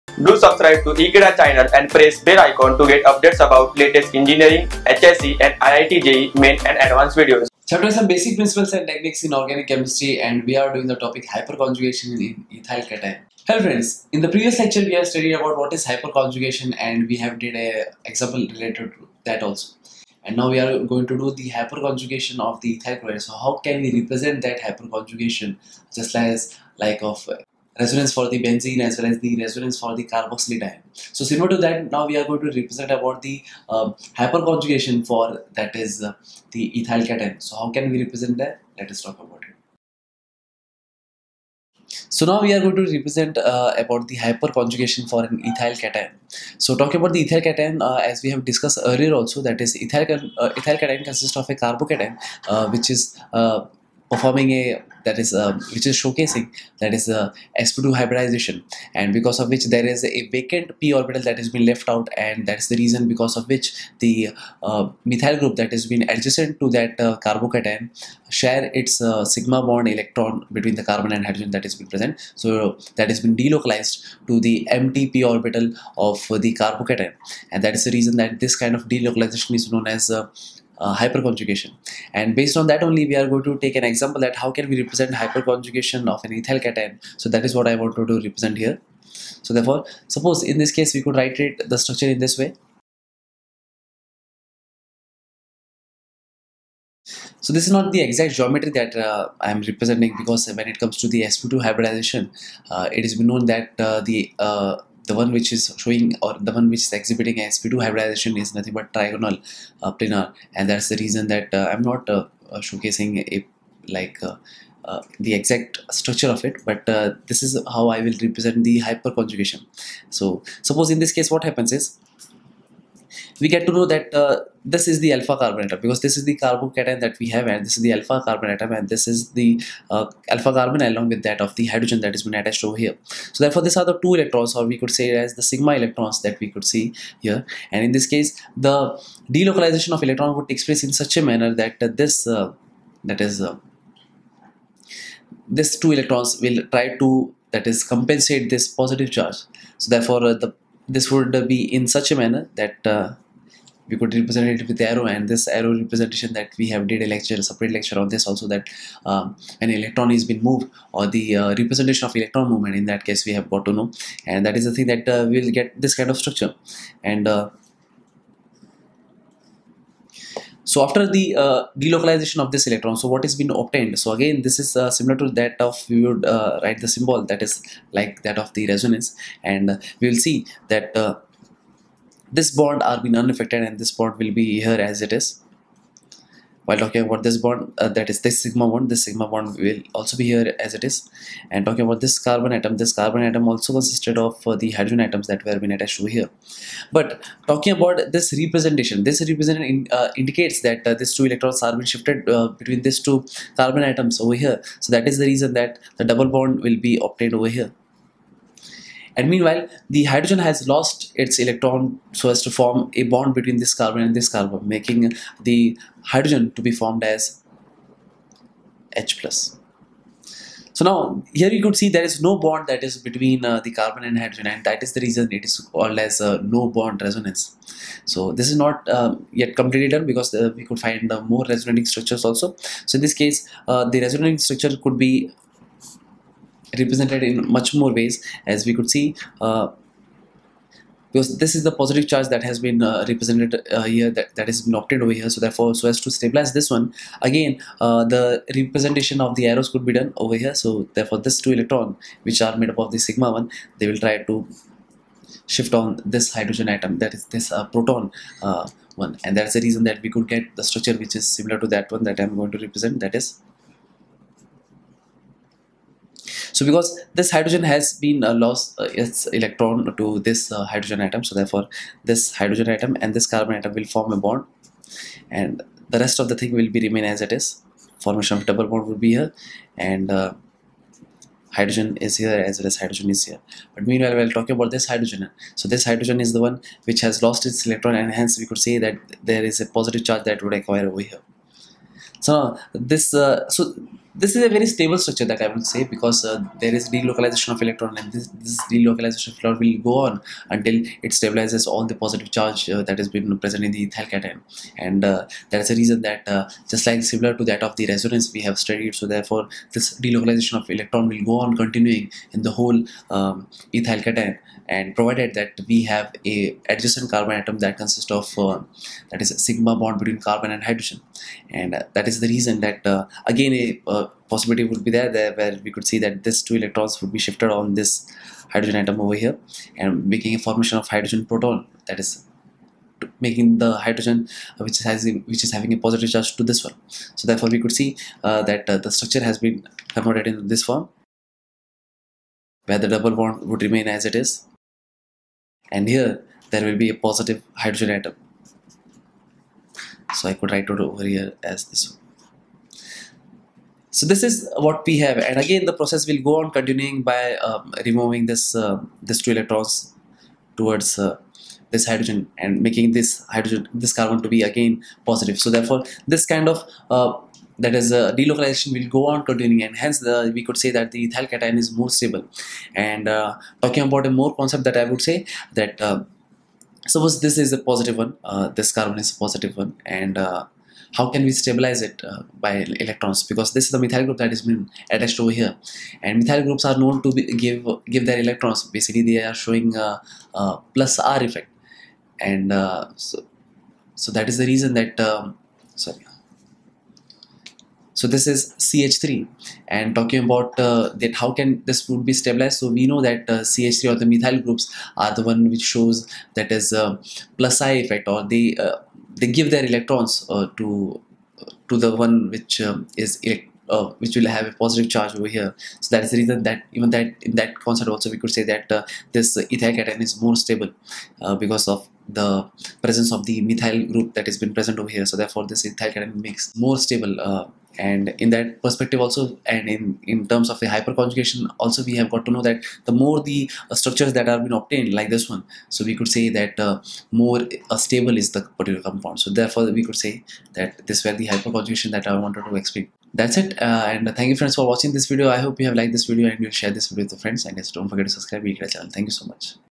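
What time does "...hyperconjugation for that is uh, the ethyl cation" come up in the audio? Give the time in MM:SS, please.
00:34.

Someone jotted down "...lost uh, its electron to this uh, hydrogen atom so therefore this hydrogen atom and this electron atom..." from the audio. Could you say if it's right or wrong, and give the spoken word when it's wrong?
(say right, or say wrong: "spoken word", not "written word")
wrong: "carbon", not "electron".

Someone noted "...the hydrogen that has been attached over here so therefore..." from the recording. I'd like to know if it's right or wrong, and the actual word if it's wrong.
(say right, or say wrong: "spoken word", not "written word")
right.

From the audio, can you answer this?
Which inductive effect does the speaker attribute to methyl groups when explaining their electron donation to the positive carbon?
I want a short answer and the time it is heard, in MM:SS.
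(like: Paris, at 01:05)
Plus I effect, at 06:47.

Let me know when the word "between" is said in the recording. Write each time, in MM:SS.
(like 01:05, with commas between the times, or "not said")
01:10, 03:22, 03:33, 03:42, 05:19.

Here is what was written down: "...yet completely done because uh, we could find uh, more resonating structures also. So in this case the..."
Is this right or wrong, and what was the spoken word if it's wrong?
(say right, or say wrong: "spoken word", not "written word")
right.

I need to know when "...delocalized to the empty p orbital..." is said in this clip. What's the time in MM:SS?
01:13.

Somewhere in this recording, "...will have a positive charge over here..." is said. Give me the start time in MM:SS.
06:54.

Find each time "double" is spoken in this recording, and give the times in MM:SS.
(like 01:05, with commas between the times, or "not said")
03:26, 04:38, 05:42.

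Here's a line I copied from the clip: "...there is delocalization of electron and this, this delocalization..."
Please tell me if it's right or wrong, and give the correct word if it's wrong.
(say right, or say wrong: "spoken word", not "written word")
right.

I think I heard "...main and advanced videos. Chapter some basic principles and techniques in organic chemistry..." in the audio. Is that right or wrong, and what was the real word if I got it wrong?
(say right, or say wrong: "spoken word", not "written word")
right.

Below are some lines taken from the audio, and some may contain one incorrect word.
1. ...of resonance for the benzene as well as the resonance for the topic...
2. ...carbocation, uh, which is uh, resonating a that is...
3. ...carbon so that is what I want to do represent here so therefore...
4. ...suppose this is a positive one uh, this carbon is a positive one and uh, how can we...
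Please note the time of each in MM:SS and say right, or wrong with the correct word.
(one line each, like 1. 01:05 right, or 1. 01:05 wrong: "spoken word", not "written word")
1. 00:27 wrong: "carboxylic", not "topic"
2. 00:51 wrong: "performing", not "resonating"
3. 01:26 wrong: "cation", not "carbon"
4. 06:16 right.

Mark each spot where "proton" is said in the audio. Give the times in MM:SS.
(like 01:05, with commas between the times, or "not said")
04:17, 05:31.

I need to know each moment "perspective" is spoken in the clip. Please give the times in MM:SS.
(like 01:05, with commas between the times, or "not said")
07:08.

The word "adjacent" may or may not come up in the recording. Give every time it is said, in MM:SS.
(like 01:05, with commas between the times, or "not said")
01:06, 05:16.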